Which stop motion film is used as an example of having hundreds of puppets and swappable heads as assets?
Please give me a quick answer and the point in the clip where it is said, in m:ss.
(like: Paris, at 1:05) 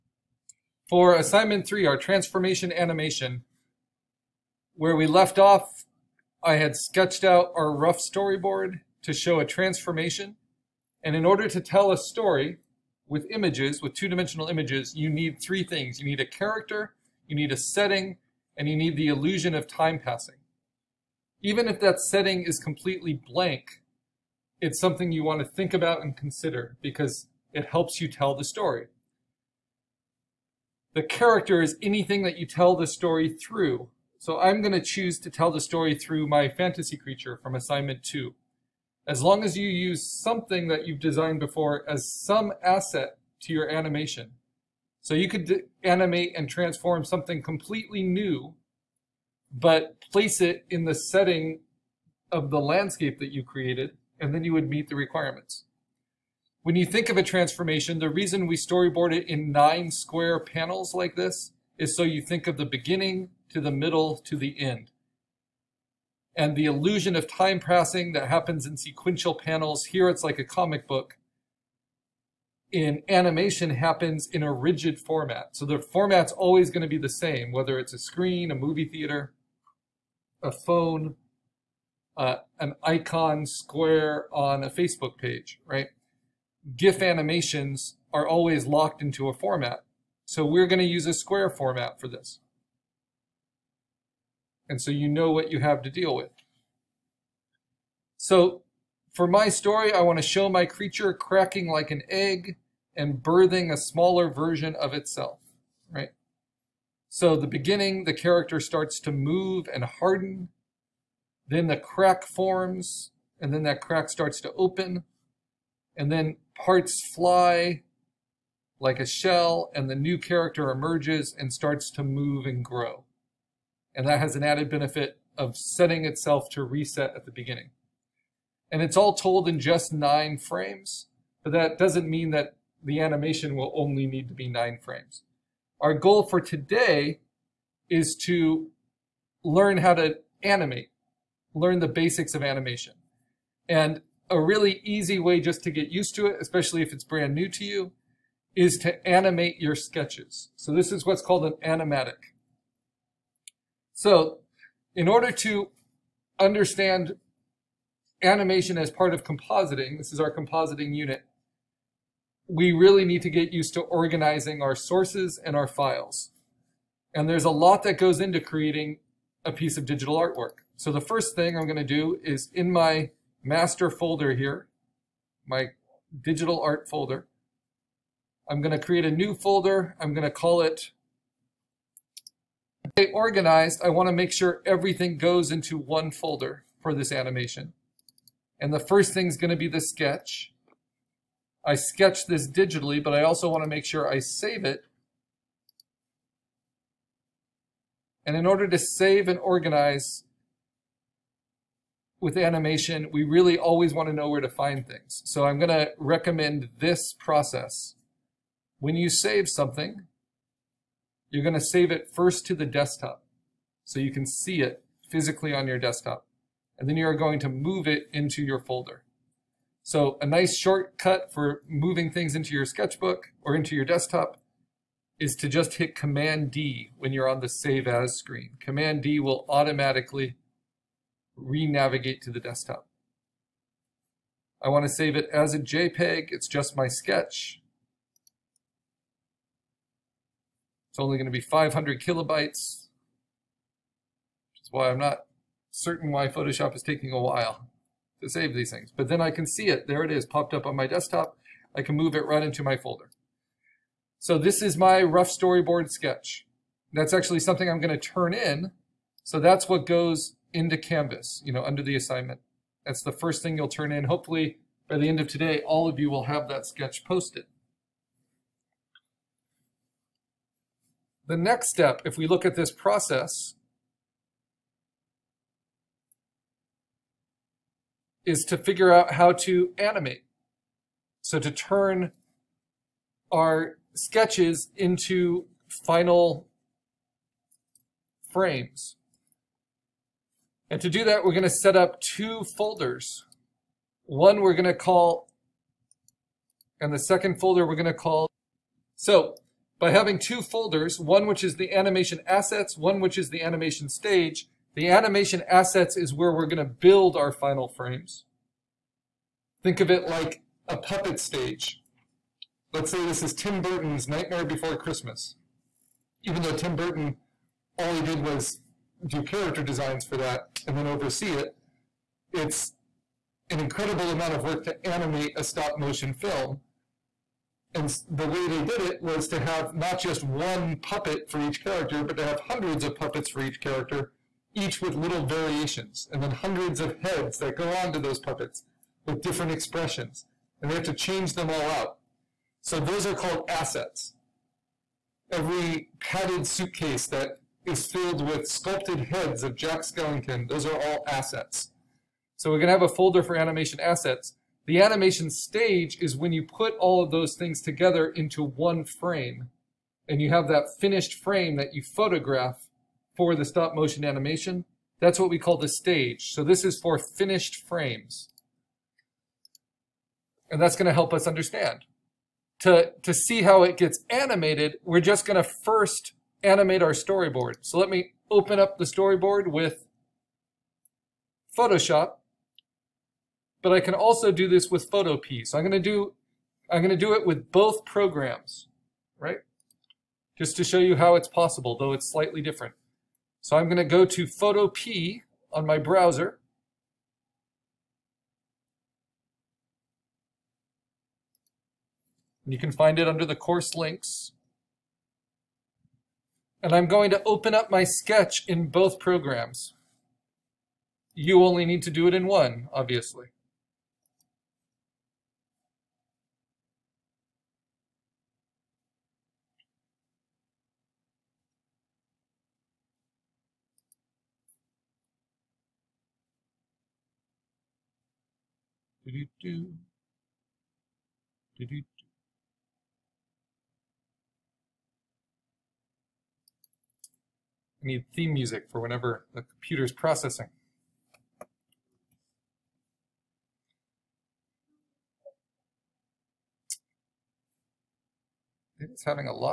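Nightmare Before Christmas, at 5:14.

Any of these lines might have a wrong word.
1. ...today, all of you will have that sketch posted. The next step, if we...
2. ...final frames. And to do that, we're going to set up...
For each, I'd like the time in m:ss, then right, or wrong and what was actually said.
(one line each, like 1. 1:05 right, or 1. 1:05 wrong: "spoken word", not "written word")
1. 4:25 right
2. 4:45 right.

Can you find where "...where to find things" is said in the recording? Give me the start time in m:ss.
3:24.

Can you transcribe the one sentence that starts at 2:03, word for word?
And that has an added benefit of setting itself to reset at the beginning.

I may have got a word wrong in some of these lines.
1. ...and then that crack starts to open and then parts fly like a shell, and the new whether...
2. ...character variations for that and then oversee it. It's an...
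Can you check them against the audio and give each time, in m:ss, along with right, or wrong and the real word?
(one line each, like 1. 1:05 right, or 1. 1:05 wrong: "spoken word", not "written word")
1. 1:53 wrong: "character", not "whether"
2. 5:19 wrong: "designs", not "variations".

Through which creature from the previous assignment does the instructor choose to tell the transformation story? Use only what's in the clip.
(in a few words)
fantasy creature.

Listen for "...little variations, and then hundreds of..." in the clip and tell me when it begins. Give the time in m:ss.
5:34.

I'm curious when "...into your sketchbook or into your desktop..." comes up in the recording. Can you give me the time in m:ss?
3:42.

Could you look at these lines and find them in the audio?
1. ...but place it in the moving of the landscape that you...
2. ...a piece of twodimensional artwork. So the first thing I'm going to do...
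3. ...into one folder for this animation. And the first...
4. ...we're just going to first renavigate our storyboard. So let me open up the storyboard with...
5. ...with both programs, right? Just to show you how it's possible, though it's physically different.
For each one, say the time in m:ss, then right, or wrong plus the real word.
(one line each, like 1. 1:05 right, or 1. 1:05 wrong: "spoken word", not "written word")
1. 0:49 wrong: "setting", not "moving"
2. 2:49 wrong: "digital", not "twodimensional"
3. 3:05 right
4. 6:14 wrong: "animate", not "renavigate"
5. 6:27 wrong: "slightly", not "physically".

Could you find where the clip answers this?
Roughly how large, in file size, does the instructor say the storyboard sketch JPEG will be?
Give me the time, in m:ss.
4:01.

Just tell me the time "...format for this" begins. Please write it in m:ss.
1:31.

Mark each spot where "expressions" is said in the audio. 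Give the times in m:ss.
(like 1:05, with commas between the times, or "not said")
5:39.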